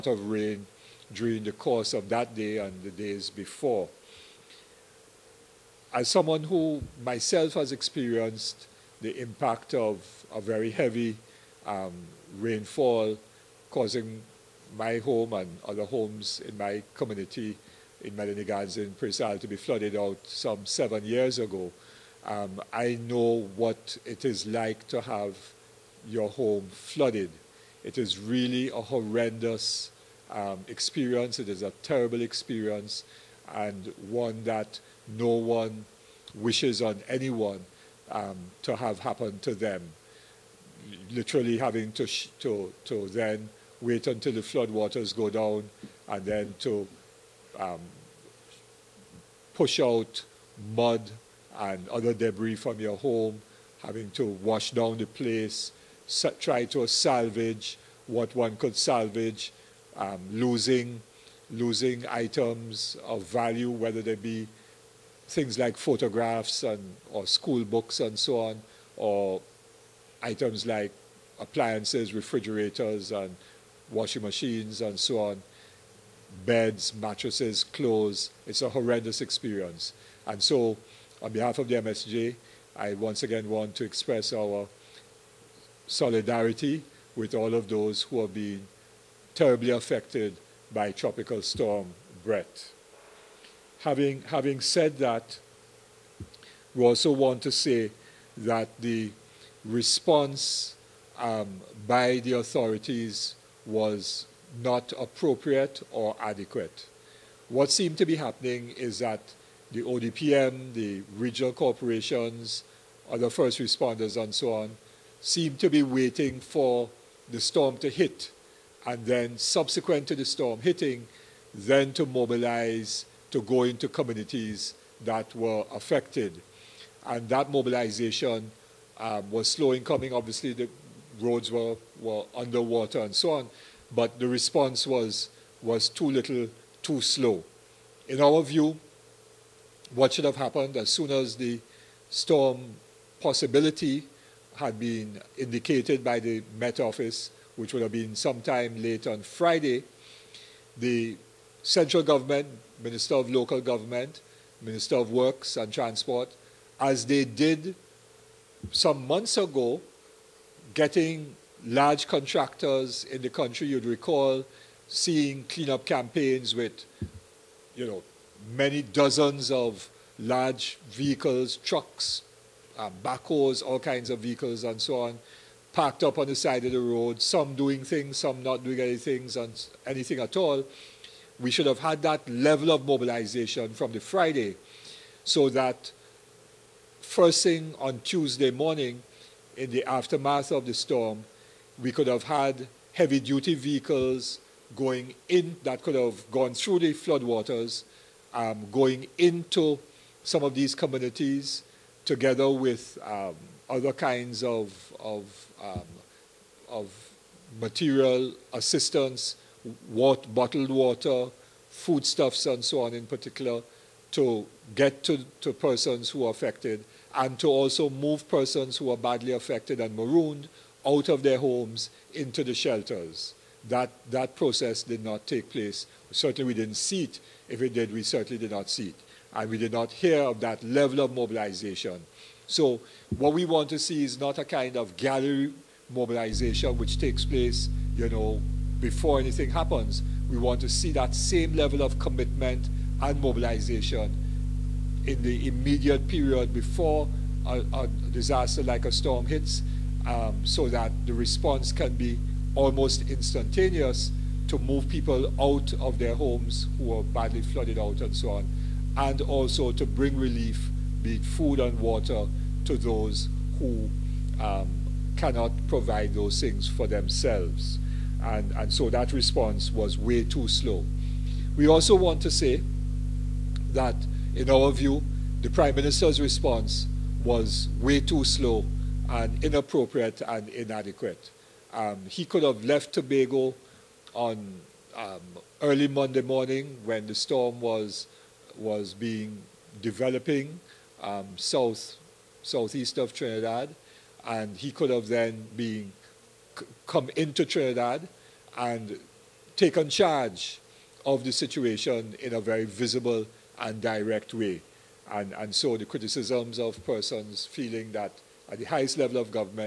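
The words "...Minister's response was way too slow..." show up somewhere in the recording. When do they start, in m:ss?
4:35.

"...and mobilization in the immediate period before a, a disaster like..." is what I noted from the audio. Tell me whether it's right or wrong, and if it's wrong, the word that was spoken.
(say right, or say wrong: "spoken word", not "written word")
right.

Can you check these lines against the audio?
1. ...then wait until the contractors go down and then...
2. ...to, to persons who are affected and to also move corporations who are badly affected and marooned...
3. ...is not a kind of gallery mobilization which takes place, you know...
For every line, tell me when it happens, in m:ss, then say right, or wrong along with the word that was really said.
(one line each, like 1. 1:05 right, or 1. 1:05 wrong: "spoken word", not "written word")
1. 0:43 wrong: "floodwaters", not "contractors"
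2. 3:35 wrong: "persons", not "corporations"
3. 3:54 right.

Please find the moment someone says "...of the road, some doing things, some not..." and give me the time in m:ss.
2:56.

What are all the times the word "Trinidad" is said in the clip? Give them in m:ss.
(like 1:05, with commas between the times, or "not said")
4:53, 4:57.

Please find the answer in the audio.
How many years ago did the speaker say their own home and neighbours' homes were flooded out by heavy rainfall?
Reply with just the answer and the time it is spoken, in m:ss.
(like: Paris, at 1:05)
7, at 0:20.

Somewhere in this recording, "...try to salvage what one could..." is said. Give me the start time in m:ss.
0:56.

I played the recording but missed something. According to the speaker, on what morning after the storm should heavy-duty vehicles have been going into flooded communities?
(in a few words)
Tuesday.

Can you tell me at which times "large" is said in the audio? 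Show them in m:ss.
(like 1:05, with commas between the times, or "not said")
2:41, 2:50.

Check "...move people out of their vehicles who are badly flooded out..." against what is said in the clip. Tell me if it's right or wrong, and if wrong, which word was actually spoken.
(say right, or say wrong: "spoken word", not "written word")
wrong: "homes", not "vehicles".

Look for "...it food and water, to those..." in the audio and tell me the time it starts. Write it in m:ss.
4:21.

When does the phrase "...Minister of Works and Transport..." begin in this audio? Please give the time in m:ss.
2:34.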